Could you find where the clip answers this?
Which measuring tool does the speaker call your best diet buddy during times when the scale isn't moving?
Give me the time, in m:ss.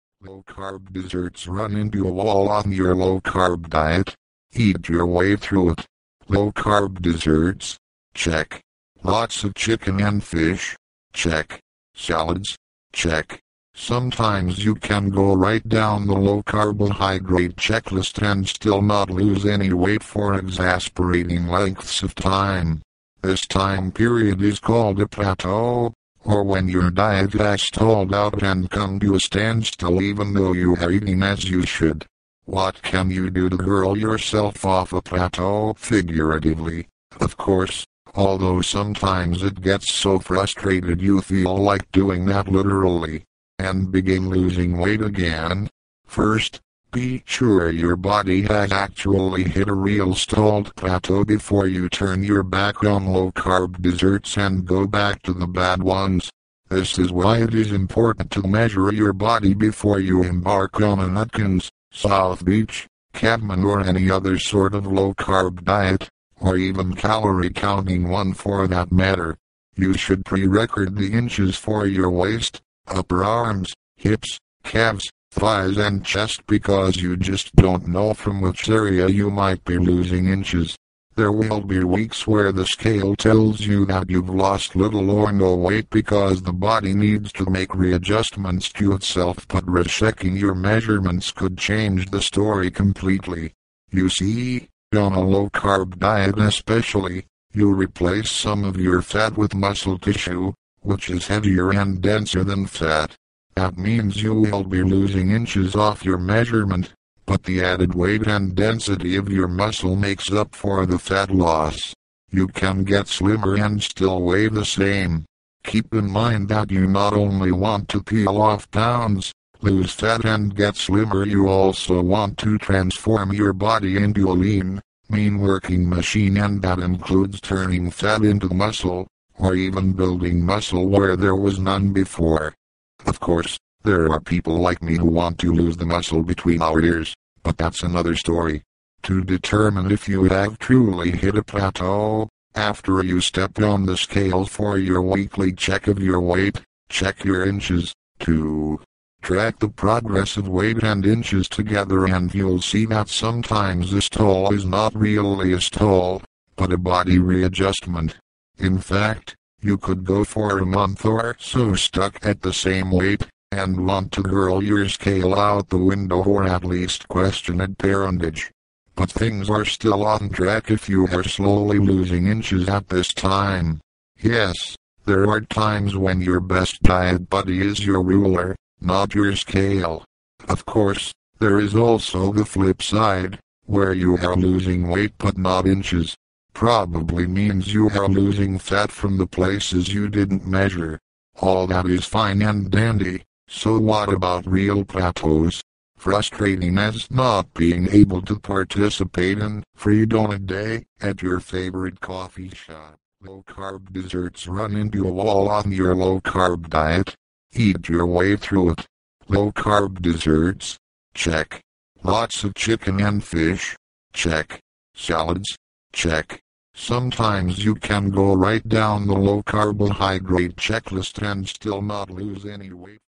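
2:58.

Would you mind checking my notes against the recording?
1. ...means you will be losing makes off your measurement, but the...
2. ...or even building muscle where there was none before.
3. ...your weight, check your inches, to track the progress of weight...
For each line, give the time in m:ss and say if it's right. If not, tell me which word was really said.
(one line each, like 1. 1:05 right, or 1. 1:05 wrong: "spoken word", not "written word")
1. 1:43 wrong: "inches", not "makes"
2. 2:09 right
3. 2:25 right.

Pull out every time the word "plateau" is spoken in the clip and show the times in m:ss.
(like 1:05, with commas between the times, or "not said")
0:25, 0:35, 0:50, 2:21, 3:14.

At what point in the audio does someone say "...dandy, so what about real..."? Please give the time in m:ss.
3:12.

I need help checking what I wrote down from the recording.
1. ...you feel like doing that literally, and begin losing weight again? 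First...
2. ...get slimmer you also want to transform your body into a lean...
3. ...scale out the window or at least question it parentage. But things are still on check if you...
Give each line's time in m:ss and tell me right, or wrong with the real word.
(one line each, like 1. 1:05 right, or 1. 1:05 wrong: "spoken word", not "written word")
1. 0:41 right
2. 2:00 right
3. 2:44 wrong: "track", not "check".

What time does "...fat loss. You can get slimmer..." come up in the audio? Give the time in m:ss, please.
1:50.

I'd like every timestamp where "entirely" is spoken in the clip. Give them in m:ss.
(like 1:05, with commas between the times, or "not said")
not said.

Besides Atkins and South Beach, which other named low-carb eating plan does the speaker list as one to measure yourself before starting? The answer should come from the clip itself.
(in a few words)
Caveman.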